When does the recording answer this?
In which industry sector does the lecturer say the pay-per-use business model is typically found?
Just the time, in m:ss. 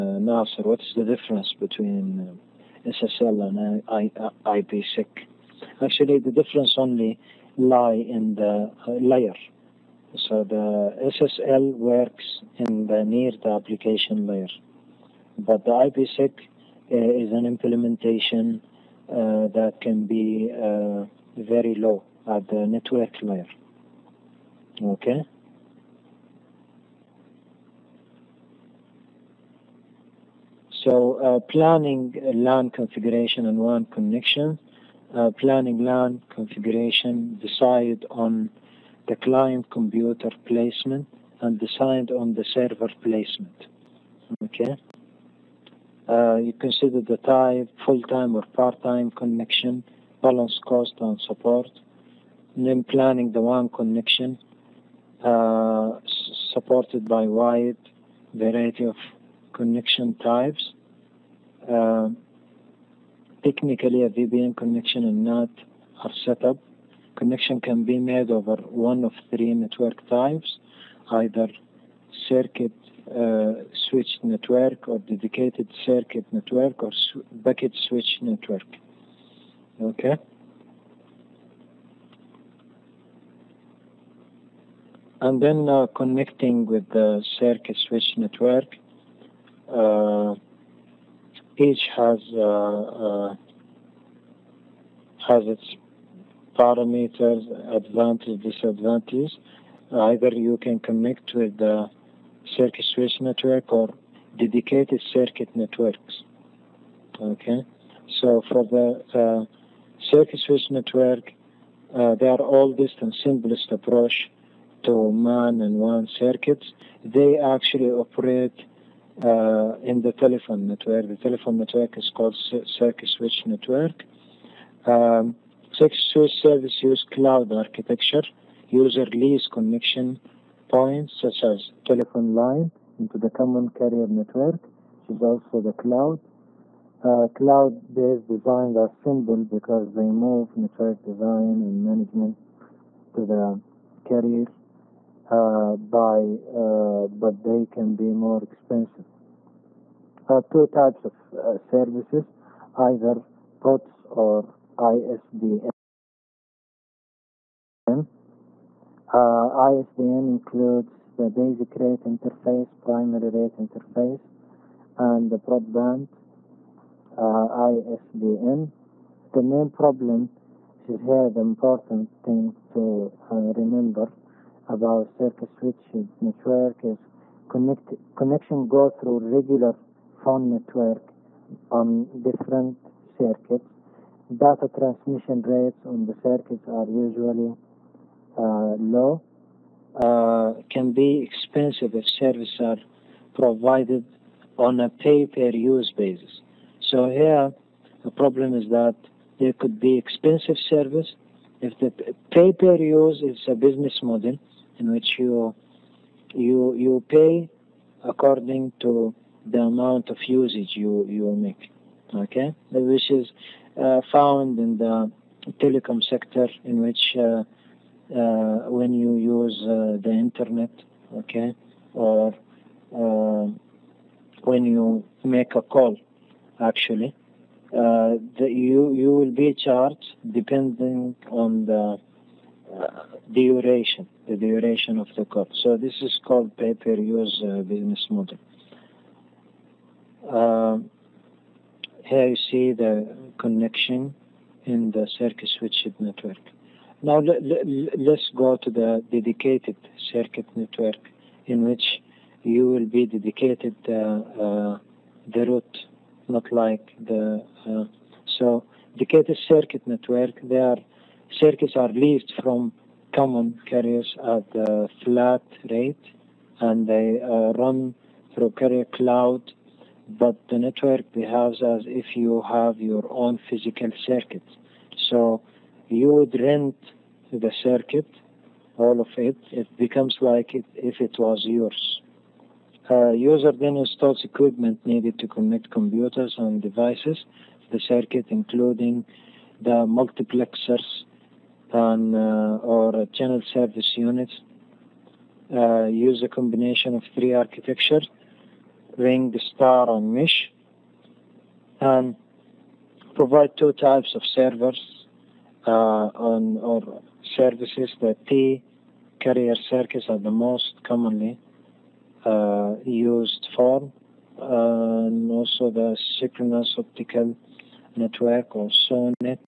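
3:35.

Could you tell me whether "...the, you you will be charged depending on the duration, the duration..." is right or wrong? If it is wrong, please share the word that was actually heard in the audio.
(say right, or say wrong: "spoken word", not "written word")
right.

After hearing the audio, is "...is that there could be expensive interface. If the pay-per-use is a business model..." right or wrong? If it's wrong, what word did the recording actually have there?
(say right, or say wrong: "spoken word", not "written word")
wrong: "service", not "interface".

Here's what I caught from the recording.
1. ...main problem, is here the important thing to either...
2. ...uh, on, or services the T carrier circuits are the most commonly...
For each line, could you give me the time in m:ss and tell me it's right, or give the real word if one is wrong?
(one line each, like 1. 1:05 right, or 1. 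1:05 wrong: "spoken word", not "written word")
1. 2:49 wrong: "remember", not "either"
2. 5:05 right.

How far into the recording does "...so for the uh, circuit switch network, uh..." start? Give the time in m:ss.
1:48.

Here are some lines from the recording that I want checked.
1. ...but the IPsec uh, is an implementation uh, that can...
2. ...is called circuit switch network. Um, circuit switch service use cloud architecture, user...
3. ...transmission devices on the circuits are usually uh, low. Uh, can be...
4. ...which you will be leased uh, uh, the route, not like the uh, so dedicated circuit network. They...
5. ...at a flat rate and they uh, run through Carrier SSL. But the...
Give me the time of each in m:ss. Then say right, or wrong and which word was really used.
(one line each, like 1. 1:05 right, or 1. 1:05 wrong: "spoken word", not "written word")
1. 0:15 right
2. 2:01 right
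3. 3:04 wrong: "rates", not "devices"
4. 4:11 wrong: "dedicated", not "leased"
5. 4:24 wrong: "Cloud", not "SSL".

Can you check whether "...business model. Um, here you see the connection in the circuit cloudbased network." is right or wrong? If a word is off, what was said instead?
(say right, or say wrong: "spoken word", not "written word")
wrong: "switched", not "cloudbased".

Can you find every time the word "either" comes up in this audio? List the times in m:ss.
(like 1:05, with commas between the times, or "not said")
1:11, 1:39, 2:32.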